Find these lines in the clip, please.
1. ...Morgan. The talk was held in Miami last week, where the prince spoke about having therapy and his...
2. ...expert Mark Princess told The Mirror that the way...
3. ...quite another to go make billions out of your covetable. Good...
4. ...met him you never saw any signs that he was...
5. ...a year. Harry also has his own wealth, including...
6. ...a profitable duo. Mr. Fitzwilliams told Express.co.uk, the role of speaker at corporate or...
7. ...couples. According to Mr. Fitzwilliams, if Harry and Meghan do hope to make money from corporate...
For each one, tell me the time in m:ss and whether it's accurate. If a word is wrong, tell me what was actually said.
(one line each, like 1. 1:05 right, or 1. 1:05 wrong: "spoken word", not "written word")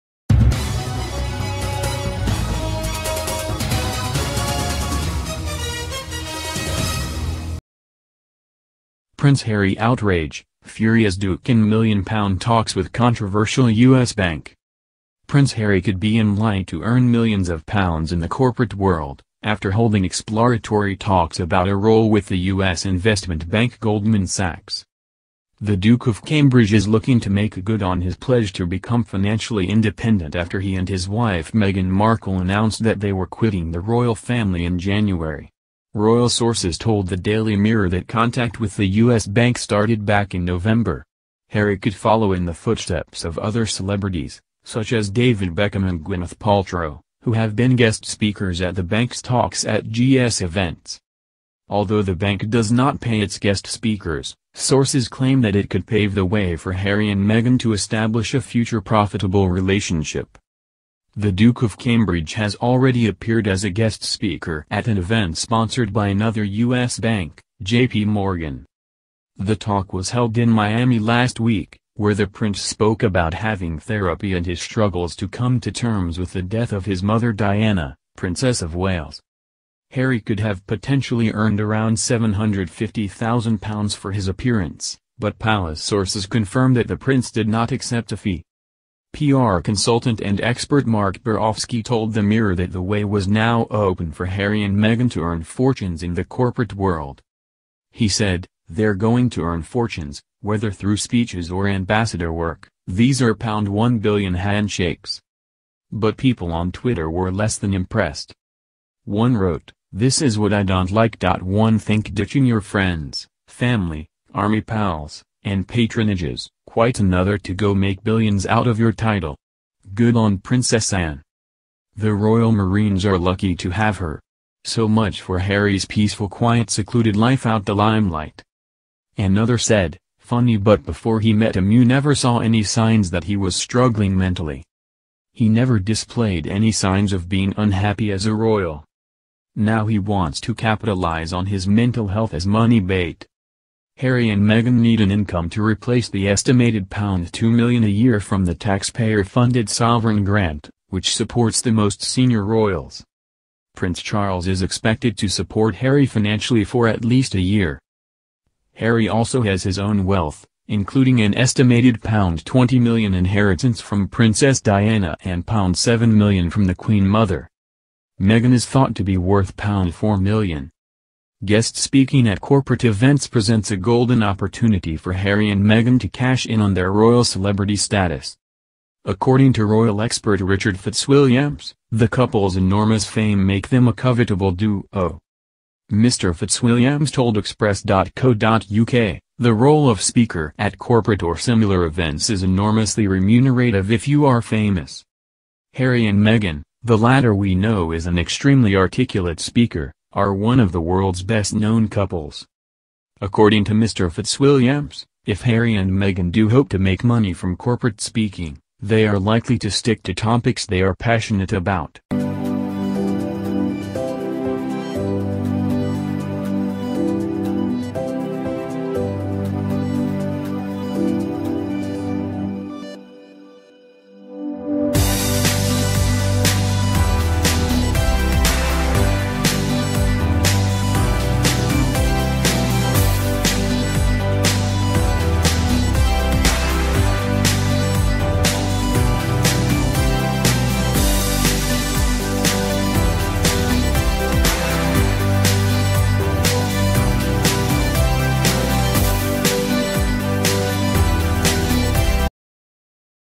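1. 1:08 right
2. 1:30 wrong: "Borkowski", not "Princess"
3. 1:56 wrong: "title", not "covetable"
4. 2:11 right
5. 2:37 right
6. 3:03 wrong: "covetable", not "profitable"
7. 3:21 right.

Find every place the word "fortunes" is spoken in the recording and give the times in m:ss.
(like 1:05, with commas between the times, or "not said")
1:35, 1:39.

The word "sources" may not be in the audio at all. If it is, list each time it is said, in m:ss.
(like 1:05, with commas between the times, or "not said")
0:36, 0:54, 1:25.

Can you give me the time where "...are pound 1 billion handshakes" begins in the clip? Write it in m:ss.
1:43.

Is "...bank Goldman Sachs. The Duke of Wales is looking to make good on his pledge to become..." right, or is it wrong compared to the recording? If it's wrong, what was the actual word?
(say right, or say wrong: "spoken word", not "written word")
wrong: "Cambridge", not "Wales".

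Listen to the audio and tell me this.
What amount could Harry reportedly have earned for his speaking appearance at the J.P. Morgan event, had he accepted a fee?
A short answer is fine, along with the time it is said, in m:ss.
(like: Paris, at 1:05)
£750,000, at 1:21.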